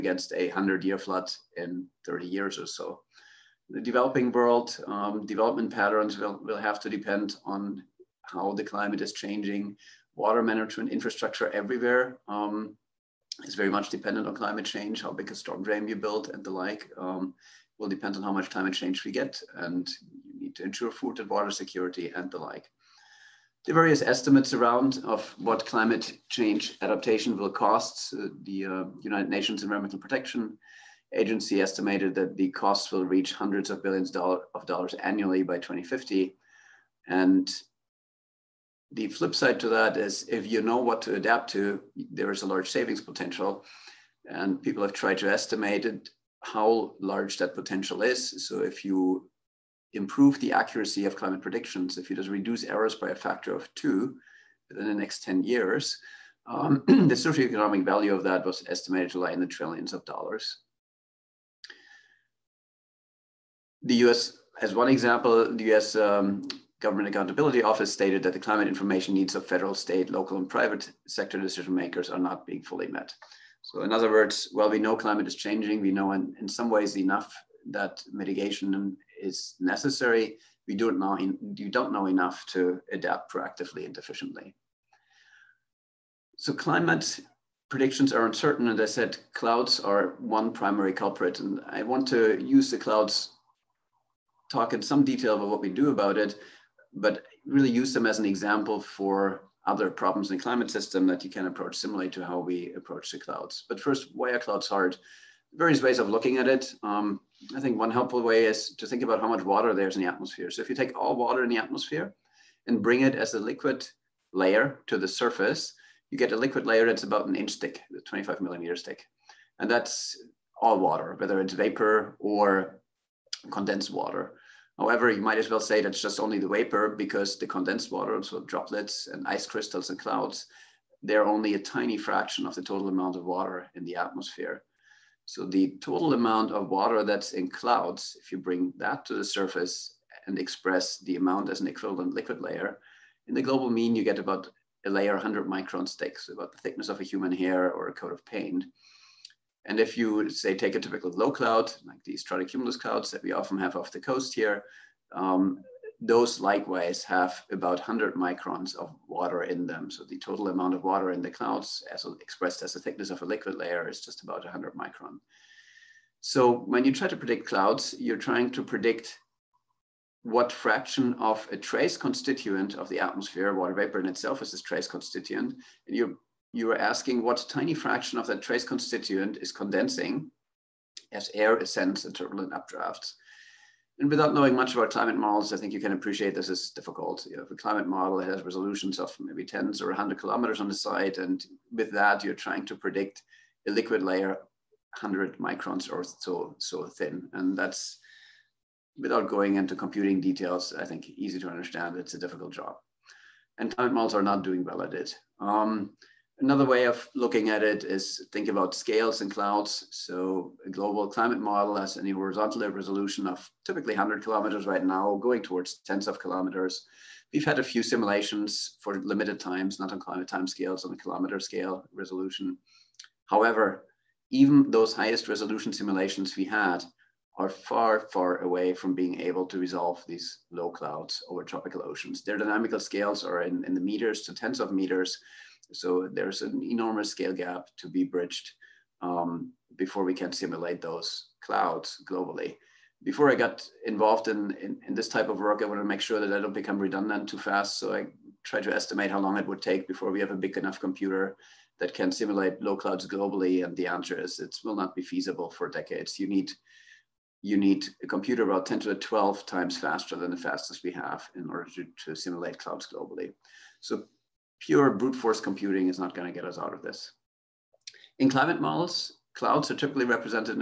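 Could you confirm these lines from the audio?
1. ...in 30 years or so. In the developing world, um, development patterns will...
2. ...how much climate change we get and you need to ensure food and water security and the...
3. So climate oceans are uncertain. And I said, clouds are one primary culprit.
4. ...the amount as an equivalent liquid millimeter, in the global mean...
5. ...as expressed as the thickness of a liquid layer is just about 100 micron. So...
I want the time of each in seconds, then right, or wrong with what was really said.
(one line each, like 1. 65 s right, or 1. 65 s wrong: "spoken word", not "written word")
1. 1 s right
2. 18 s right
3. 86 s wrong: "predictions", not "oceans"
4. 140 s wrong: "layer", not "millimeter"
5. 161 s right.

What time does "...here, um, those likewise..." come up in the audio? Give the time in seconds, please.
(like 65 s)
154 s.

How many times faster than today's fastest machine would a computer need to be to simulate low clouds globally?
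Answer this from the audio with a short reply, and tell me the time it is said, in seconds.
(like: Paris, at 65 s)
10^12, at 258 s.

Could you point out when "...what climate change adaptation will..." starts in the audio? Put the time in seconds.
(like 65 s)
25 s.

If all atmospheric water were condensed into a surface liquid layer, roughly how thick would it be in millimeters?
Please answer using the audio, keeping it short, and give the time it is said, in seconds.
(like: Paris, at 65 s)
25 millimeters, at 118 s.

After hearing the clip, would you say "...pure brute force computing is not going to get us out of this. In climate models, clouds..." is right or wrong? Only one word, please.
right.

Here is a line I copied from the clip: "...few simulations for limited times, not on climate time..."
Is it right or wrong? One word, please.
right.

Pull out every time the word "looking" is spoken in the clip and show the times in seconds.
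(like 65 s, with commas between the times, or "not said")
106 s, 207 s.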